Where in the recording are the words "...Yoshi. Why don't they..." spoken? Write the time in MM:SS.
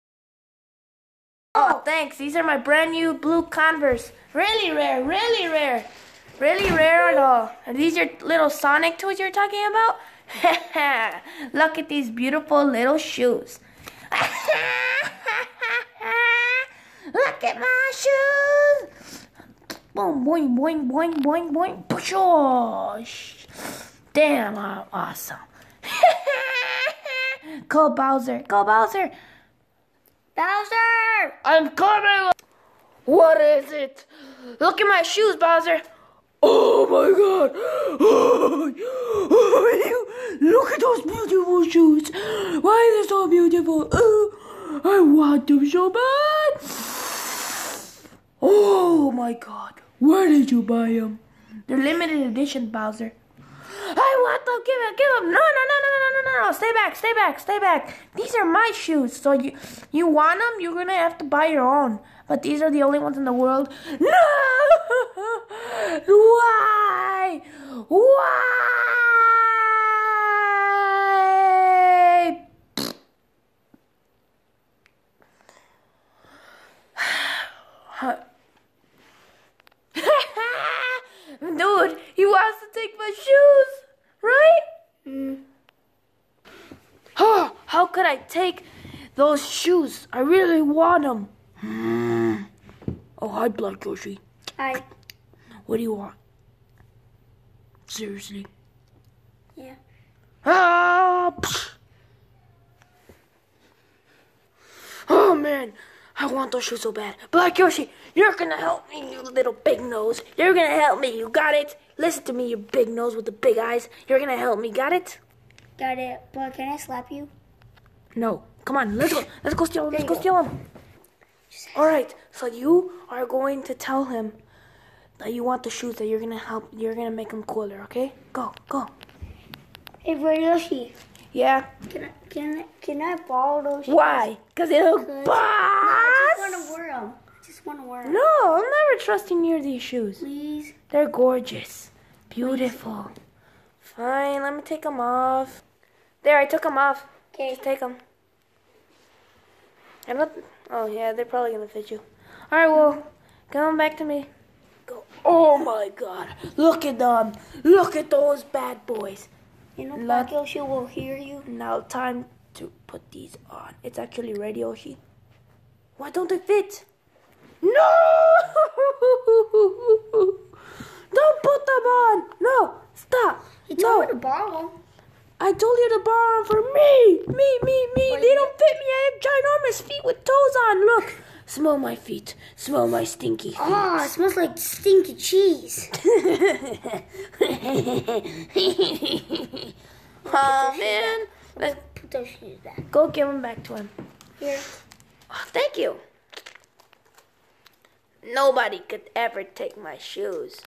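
02:44.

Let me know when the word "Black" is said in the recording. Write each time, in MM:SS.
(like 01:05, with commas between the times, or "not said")
01:33, 01:47, 02:10, 02:39.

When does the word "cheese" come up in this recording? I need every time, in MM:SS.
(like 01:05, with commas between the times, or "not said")
03:05.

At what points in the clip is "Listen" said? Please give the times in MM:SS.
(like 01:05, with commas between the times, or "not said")
01:51.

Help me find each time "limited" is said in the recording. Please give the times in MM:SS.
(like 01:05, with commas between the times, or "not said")
00:51.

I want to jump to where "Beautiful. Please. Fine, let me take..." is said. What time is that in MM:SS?
02:22.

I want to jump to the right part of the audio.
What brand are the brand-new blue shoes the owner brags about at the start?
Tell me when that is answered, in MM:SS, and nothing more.
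00:03.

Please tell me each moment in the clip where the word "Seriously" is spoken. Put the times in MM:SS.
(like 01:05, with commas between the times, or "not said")
01:37.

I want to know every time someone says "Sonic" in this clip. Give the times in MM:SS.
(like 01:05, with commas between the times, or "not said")
00:08.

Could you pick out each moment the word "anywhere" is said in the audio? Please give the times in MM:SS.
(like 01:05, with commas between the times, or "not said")
not said.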